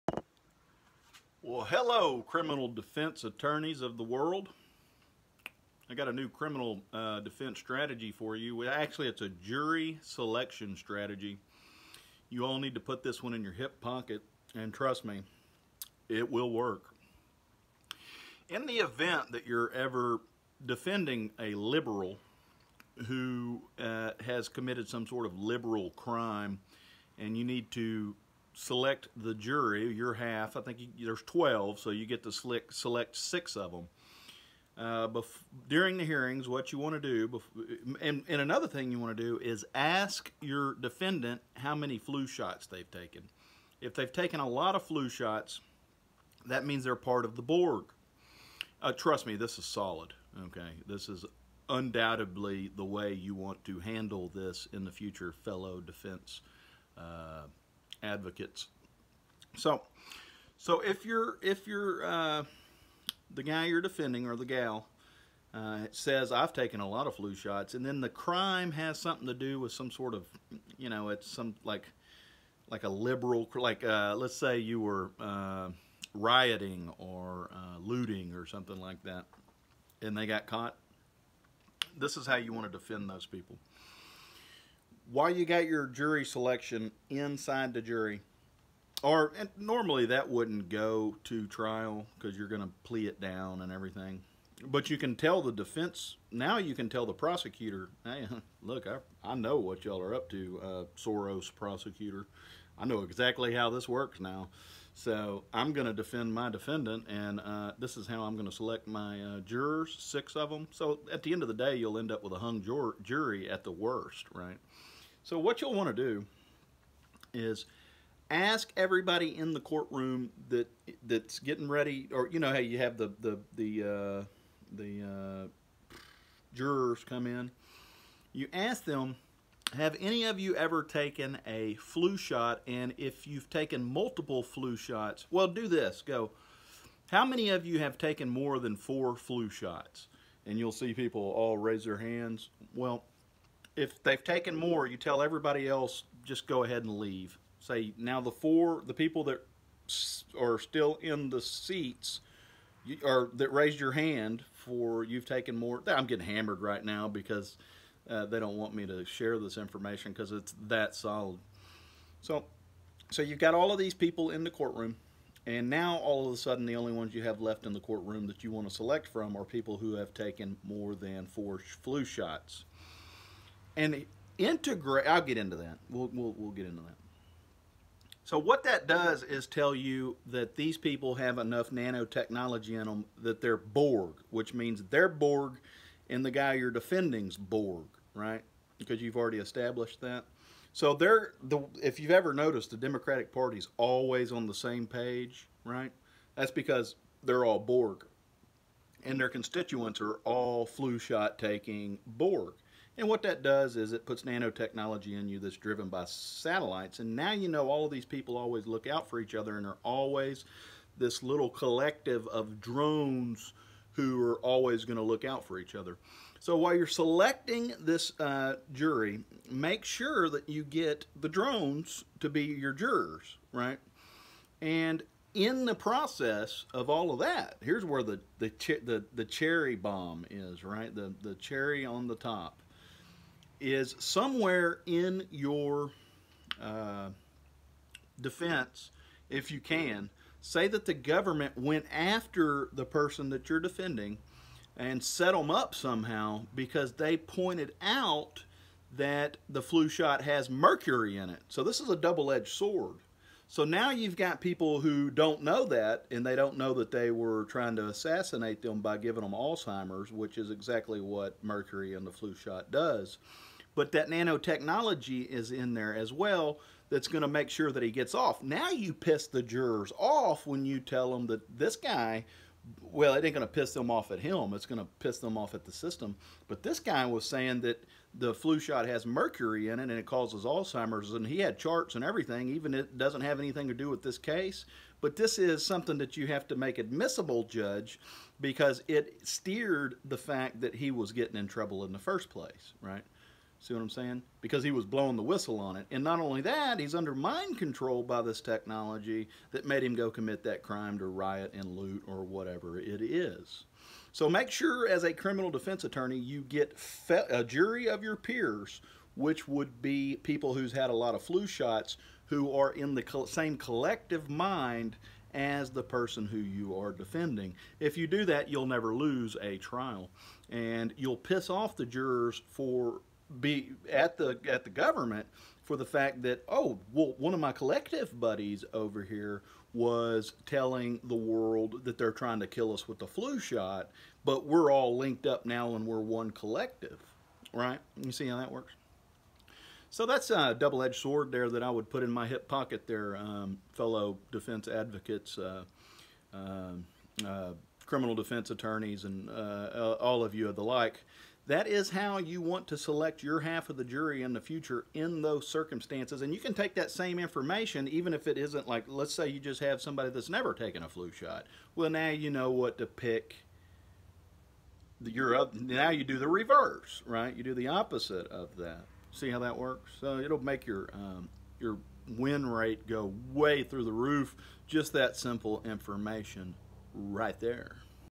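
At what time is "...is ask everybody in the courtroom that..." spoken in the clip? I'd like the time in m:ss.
1:57.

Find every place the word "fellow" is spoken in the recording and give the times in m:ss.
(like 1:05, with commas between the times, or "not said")
0:55, 5:43.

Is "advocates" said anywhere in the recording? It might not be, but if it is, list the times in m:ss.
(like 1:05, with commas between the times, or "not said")
0:58, 5:44.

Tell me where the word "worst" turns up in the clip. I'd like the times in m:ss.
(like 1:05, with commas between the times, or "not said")
1:53.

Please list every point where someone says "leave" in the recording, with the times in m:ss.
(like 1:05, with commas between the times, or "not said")
2:26.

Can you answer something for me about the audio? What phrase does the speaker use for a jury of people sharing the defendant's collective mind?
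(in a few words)
jury of your peers.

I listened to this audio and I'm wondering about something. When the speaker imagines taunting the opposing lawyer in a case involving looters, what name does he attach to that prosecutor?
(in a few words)
Soros.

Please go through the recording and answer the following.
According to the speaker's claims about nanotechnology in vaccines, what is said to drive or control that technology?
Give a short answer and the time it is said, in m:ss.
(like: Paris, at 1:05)
satellites, at 3:26.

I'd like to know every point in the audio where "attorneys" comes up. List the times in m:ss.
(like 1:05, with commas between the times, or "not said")
0:03, 5:05, 5:48.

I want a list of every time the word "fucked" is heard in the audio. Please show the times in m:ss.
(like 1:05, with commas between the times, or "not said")
not said.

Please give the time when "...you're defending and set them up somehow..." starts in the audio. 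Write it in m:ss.
4:03.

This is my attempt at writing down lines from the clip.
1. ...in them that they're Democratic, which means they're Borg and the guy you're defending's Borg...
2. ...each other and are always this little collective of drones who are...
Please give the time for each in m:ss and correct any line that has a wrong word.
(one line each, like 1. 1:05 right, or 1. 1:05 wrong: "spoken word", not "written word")
1. 3:02 wrong: "Borg", not "Democratic"
2. 3:29 right.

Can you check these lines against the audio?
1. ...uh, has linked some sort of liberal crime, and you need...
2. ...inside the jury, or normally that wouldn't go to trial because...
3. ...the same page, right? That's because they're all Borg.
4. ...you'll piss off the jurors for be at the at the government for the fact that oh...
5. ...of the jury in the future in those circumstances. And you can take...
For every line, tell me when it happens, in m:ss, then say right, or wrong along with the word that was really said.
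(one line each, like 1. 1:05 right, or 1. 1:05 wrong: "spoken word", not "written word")
1. 0:23 wrong: "committed", not "linked"
2. 1:27 right
3. 3:14 right
4. 5:20 right
5. 5:53 right.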